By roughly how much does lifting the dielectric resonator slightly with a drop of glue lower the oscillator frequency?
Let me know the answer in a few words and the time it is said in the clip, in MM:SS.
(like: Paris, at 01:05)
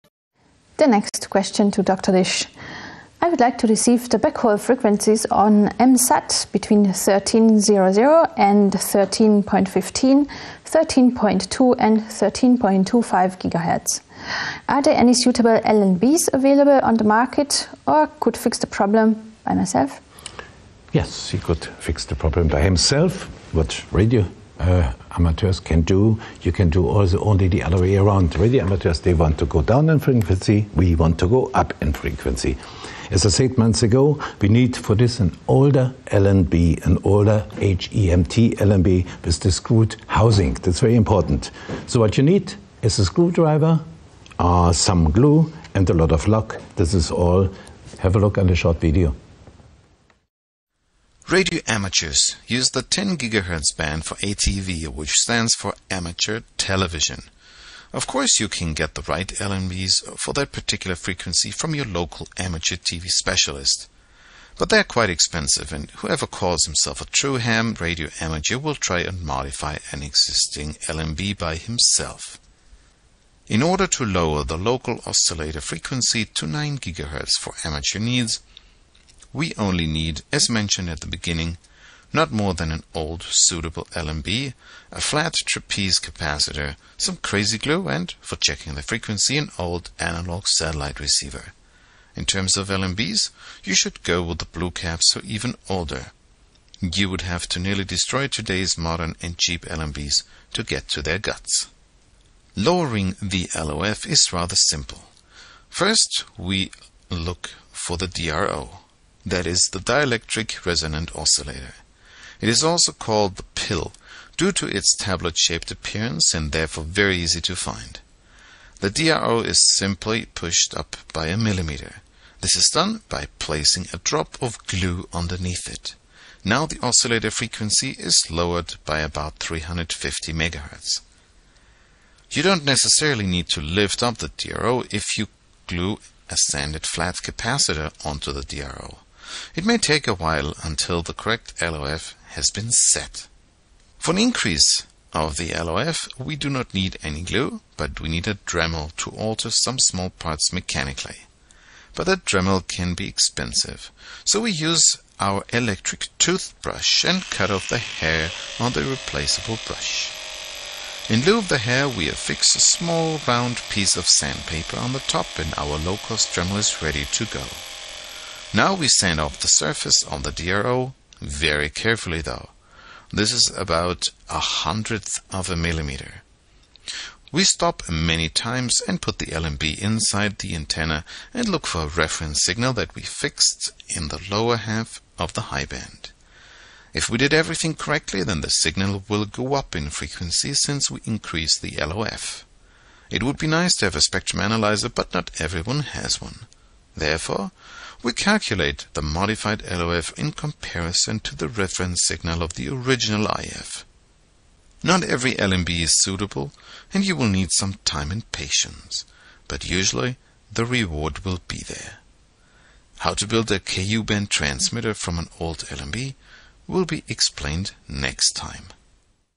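350 MHz, at 02:09.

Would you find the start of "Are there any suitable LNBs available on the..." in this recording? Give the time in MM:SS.
00:14.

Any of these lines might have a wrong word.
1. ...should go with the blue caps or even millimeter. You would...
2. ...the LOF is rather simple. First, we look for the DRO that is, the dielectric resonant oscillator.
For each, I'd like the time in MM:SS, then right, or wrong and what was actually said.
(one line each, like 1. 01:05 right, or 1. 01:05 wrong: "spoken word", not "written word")
1. 01:33 wrong: "older", not "millimeter"
2. 01:43 right.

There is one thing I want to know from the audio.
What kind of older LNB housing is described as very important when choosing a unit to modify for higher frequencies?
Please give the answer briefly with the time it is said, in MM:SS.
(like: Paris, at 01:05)
Screwed housing, at 00:39.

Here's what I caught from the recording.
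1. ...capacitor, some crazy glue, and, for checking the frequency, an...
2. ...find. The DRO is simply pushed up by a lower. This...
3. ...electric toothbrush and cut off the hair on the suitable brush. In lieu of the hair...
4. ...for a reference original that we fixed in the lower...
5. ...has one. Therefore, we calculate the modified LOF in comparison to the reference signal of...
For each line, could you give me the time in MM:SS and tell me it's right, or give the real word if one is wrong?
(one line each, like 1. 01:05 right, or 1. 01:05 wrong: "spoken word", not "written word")
1. 01:25 right
2. 01:57 wrong: "millimeter", not "lower"
3. 02:35 wrong: "replaceable", not "suitable"
4. 03:01 wrong: "signal", not "original"
5. 03:15 right.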